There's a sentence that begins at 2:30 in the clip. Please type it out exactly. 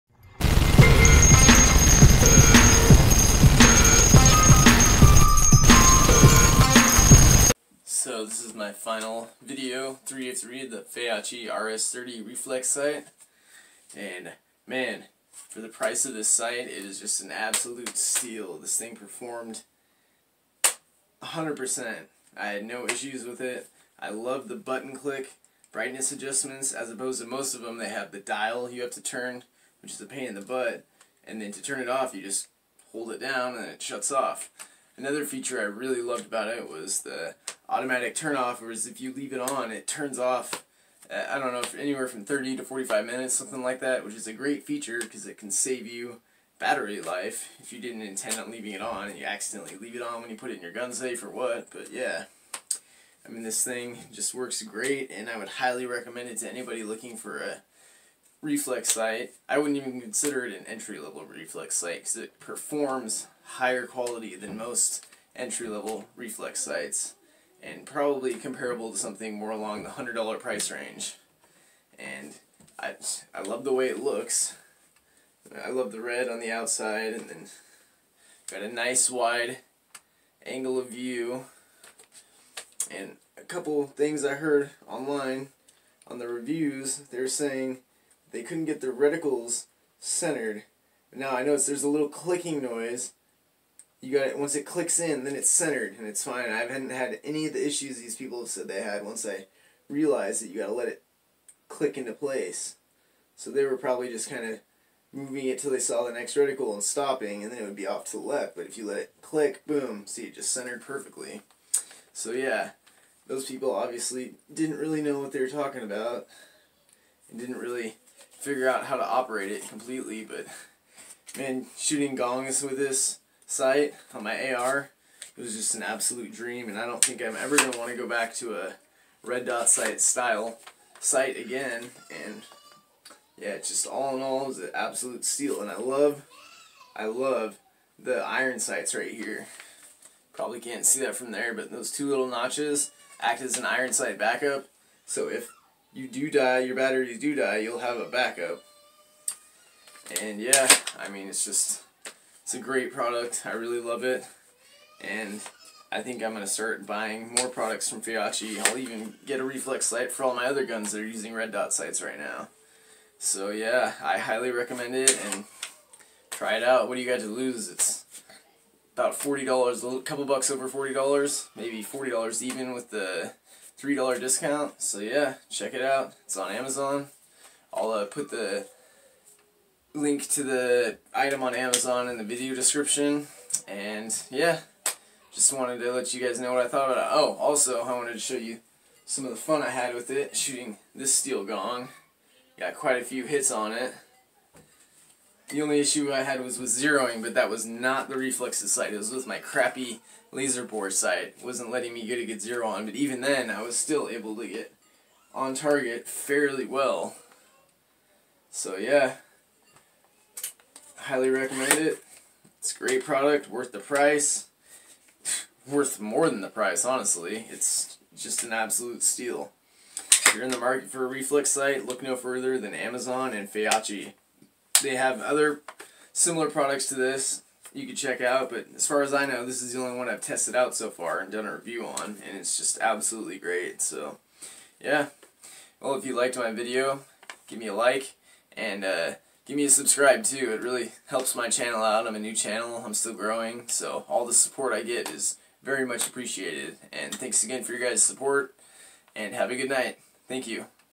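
And yeah, I mean, it's just, it's a great product.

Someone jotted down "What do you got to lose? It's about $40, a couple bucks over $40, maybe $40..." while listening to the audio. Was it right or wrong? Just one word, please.
right.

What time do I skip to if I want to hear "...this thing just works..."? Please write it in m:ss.
0:53.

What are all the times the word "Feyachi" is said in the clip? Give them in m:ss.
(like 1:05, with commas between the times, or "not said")
0:10, 2:38, 3:43.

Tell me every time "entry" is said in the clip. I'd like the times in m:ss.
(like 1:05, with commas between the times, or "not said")
1:00, 1:05.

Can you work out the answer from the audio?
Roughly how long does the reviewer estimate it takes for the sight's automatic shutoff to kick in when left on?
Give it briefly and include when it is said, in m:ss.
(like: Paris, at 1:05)
30 to 45 minutes, at 0:42.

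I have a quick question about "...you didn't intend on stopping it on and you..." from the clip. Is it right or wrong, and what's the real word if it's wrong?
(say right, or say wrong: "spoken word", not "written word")
wrong: "leaving", not "stopping".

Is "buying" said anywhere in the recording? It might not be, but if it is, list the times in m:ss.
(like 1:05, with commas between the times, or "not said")
2:36.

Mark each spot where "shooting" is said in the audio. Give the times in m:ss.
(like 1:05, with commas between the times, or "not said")
2:01, 3:10.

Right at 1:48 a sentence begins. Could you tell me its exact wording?
But if you let it click, boom, see it just centered perfectly.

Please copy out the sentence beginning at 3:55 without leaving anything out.
Well, if you liked my video, give me a like, and uh, give me a subscribe too.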